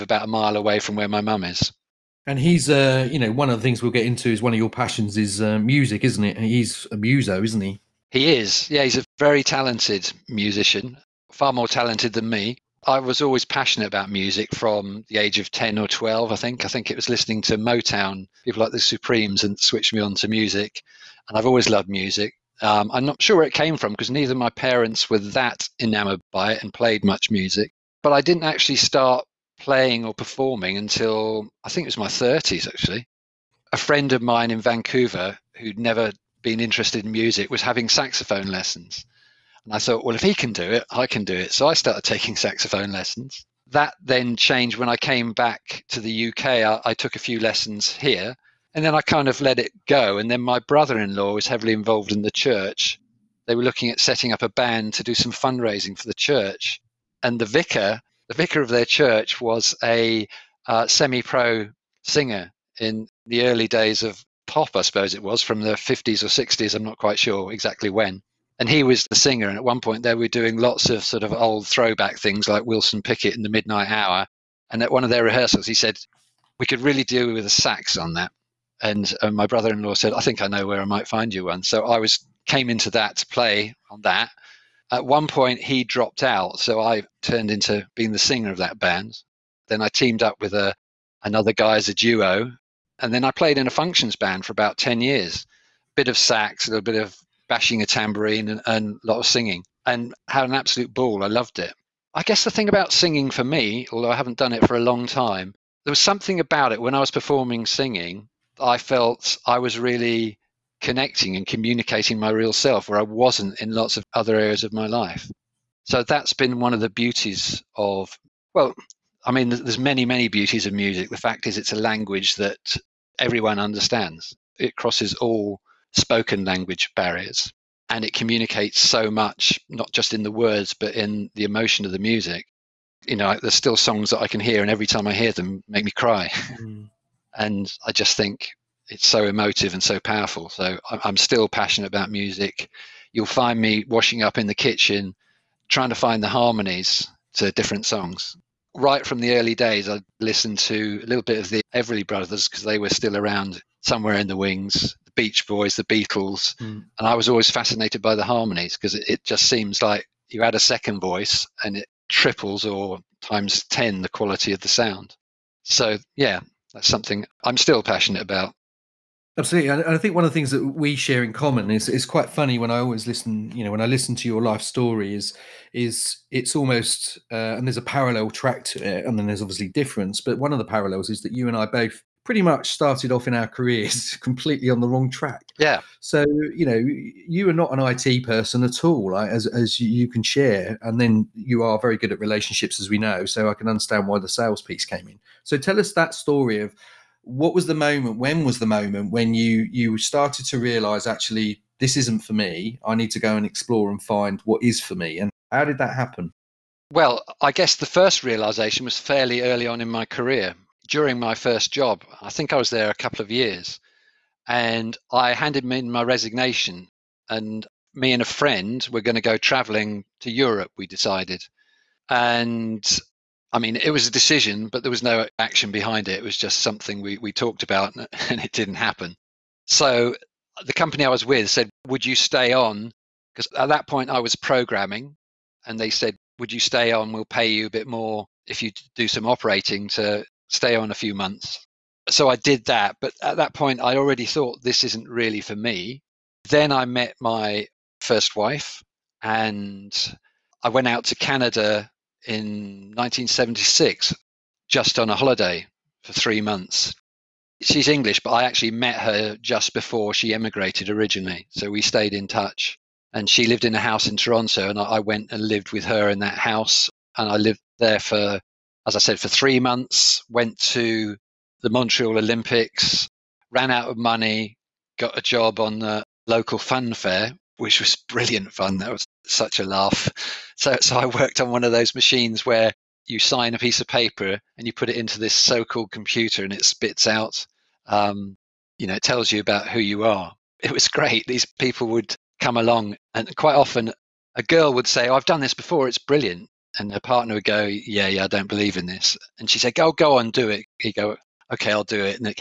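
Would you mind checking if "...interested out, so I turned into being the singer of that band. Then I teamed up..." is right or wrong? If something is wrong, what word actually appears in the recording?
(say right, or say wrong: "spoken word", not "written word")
wrong: "dropped", not "interested".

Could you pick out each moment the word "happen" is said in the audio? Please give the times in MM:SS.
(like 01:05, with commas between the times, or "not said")
03:25, 03:48.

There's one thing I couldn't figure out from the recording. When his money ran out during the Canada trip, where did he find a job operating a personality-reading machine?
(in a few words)
local fun fair.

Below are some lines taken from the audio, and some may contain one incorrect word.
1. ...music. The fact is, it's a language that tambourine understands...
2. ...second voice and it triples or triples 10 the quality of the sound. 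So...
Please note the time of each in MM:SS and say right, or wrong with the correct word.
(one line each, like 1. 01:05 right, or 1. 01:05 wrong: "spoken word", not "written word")
1. 02:00 wrong: "everyone", not "tambourine"
2. 02:40 wrong: "times", not "triples".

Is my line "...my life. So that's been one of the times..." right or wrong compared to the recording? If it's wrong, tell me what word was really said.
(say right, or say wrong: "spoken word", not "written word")
wrong: "beauties", not "times".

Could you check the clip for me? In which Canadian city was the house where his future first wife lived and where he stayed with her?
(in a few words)
Toronto.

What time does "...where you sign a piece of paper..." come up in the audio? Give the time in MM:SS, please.
04:42.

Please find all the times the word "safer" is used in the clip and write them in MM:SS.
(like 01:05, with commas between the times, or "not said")
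not said.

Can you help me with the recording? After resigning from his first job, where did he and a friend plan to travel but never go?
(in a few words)
Europe.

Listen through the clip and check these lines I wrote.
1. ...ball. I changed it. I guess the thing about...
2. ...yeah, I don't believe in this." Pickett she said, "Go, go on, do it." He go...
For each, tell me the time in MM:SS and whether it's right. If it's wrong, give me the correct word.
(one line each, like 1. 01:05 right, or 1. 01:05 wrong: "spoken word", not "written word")
1. 01:40 wrong: "loved", not "changed"
2. 04:58 wrong: "And", not "Pickett".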